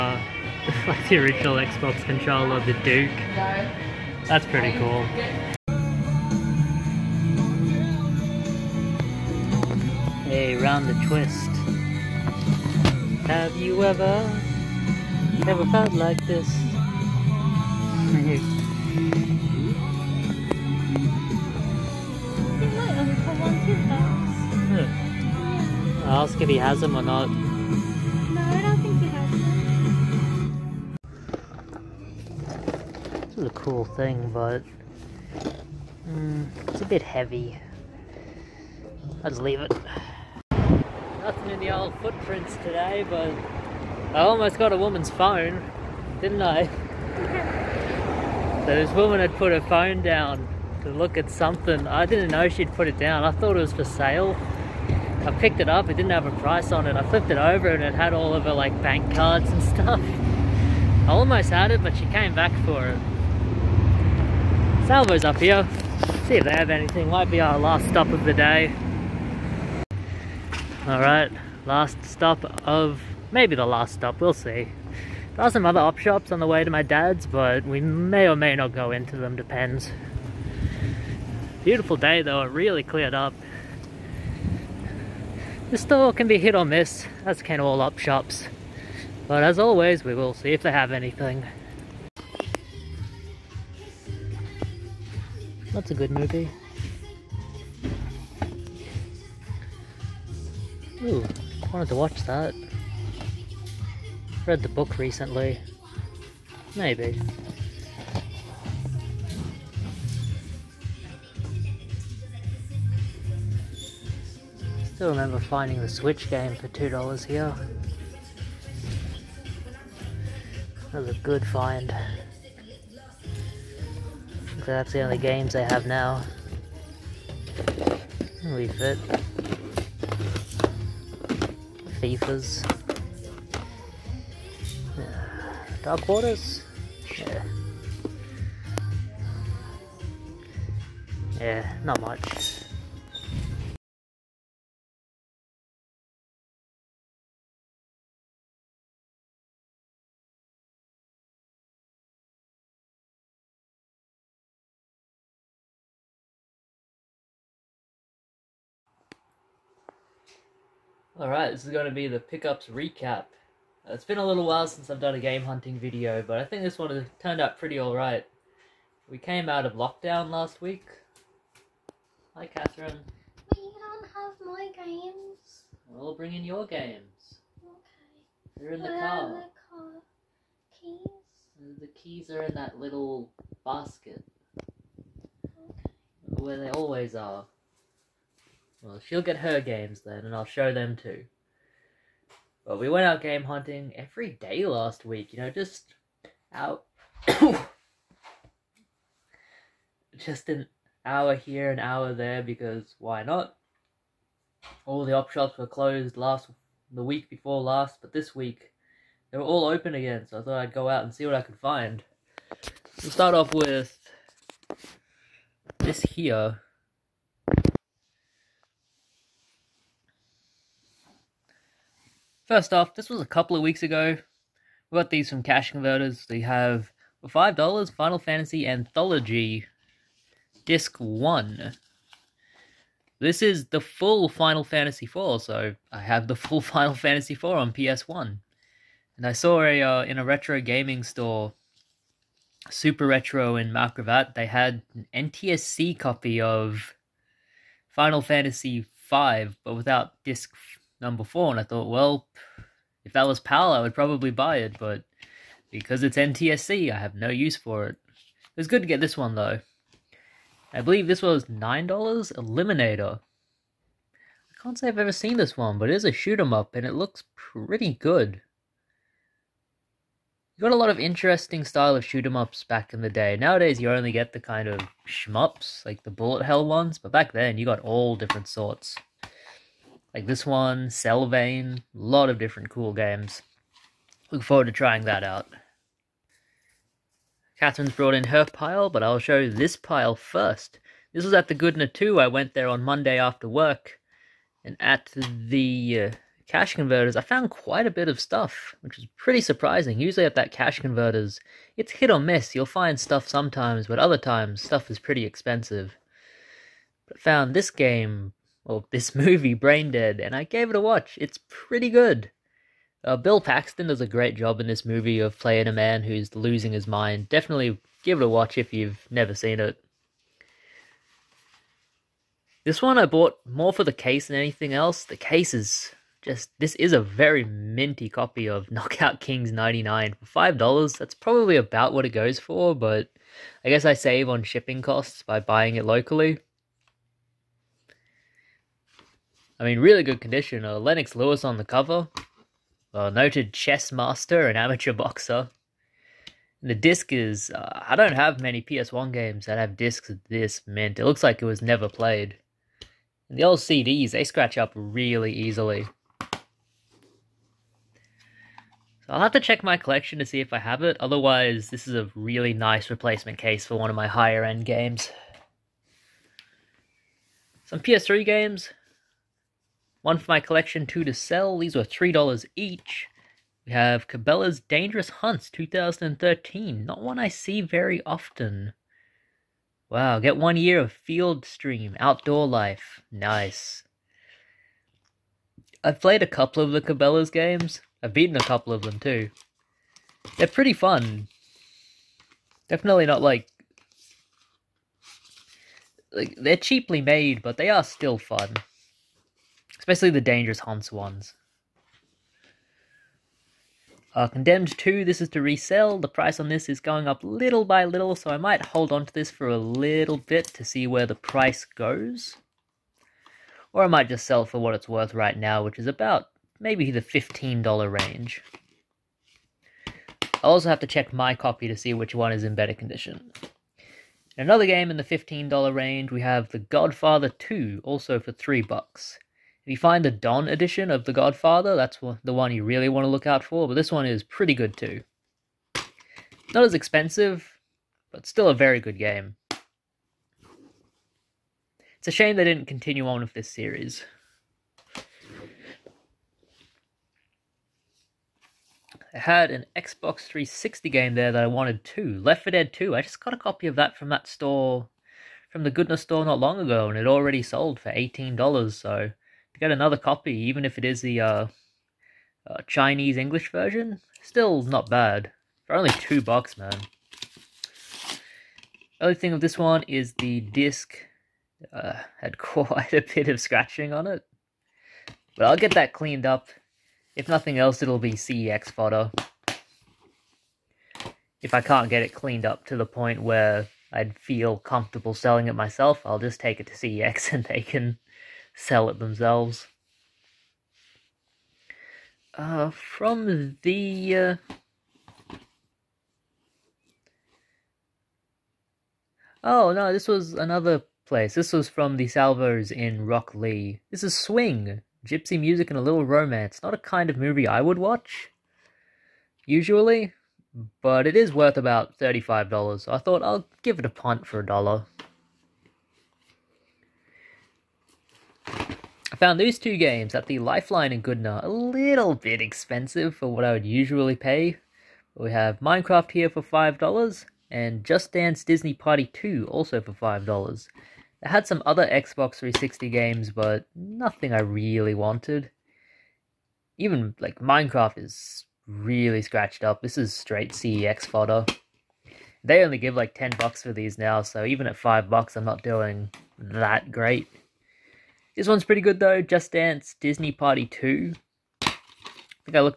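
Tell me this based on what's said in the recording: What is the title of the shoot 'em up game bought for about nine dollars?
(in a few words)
Eliminator.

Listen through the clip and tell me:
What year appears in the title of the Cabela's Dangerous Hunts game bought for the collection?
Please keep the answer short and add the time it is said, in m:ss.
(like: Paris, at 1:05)
2013, at 6:15.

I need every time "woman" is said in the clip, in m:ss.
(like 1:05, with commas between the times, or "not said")
0:44, 0:48.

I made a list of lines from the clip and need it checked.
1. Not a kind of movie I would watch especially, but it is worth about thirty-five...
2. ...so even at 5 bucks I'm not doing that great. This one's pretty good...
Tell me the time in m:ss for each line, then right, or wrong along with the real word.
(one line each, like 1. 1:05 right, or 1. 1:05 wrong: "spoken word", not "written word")
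1. 8:26 wrong: "usually", not "especially"
2. 9:04 right.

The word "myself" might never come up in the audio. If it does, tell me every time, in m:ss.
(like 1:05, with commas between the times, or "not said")
8:05.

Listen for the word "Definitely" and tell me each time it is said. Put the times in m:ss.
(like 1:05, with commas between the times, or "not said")
5:17, 6:32.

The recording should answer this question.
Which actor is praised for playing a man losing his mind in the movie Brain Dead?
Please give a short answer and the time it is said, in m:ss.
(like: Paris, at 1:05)
Bill Paxton, at 5:13.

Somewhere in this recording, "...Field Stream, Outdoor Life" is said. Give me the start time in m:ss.
6:20.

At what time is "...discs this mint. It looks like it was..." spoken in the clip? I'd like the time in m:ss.
5:49.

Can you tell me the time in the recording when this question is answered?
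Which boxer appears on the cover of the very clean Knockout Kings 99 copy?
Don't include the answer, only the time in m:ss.
5:40.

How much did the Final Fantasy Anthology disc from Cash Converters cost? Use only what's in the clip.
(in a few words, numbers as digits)
$5.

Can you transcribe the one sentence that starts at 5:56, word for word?
So I'll have to check my collection to see if I have it.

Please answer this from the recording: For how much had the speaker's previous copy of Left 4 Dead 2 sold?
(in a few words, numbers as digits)
$18.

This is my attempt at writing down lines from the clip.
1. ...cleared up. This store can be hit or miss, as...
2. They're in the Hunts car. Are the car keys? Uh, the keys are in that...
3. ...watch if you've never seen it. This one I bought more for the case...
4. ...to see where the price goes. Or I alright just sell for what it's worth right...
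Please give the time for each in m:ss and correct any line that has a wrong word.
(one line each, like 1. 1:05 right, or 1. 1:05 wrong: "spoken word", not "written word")
1. 1:22 right
2. 2:58 wrong: "Where", not "Hunts"
3. 5:18 right
4. 6:50 wrong: "might", not "alright".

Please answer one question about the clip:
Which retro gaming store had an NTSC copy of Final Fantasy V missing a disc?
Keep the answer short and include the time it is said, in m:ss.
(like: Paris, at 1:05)
Super Retro, at 4:02.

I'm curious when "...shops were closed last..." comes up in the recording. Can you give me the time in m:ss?
3:25.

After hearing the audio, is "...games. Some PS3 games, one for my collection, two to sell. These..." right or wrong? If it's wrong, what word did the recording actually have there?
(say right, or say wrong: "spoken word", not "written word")
right.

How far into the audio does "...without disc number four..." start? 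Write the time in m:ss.
4:09.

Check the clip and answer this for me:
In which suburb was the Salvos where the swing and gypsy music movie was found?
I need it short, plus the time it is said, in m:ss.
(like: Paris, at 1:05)
Rocklea, at 8:23.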